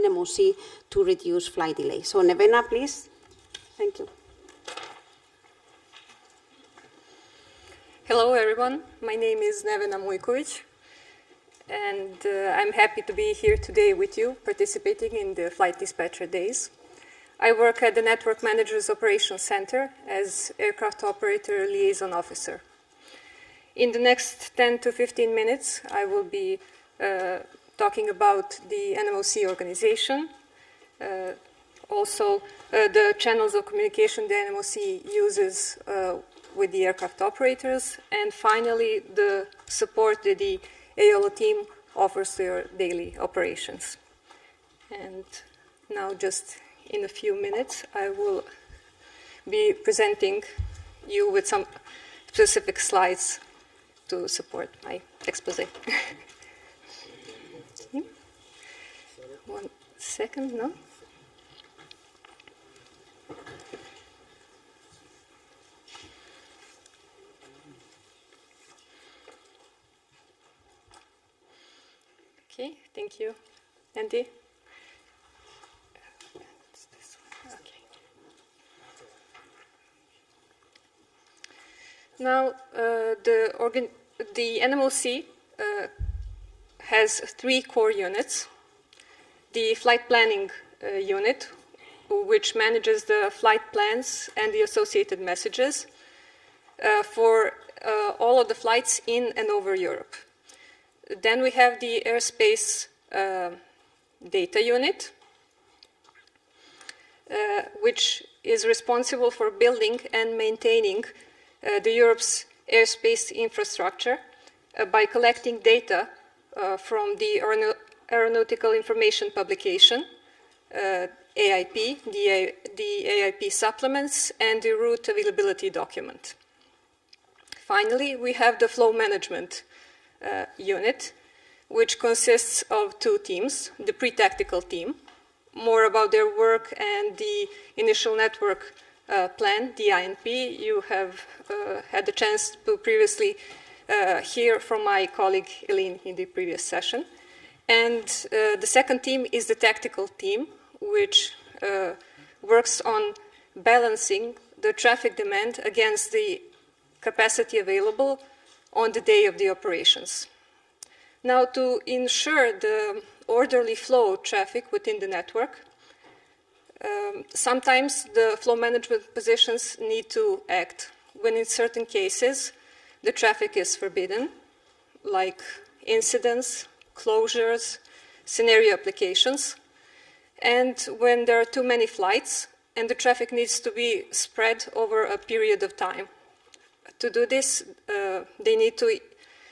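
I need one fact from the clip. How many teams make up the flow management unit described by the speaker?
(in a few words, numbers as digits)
2.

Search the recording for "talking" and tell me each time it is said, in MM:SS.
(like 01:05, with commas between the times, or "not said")
00:27.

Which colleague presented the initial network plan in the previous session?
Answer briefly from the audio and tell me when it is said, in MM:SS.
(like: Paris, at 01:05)
Eileen, at 02:25.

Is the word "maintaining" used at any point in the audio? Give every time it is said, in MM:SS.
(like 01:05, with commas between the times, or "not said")
01:50.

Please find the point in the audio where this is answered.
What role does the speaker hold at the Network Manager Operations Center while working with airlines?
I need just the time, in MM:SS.
00:20.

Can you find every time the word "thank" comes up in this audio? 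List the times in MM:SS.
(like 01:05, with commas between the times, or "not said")
00:03, 01:12.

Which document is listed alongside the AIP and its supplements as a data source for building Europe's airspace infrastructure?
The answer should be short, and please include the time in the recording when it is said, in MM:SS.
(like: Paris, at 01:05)
route availability document, at 02:04.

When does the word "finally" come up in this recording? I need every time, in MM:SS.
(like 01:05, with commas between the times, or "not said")
00:38, 02:07.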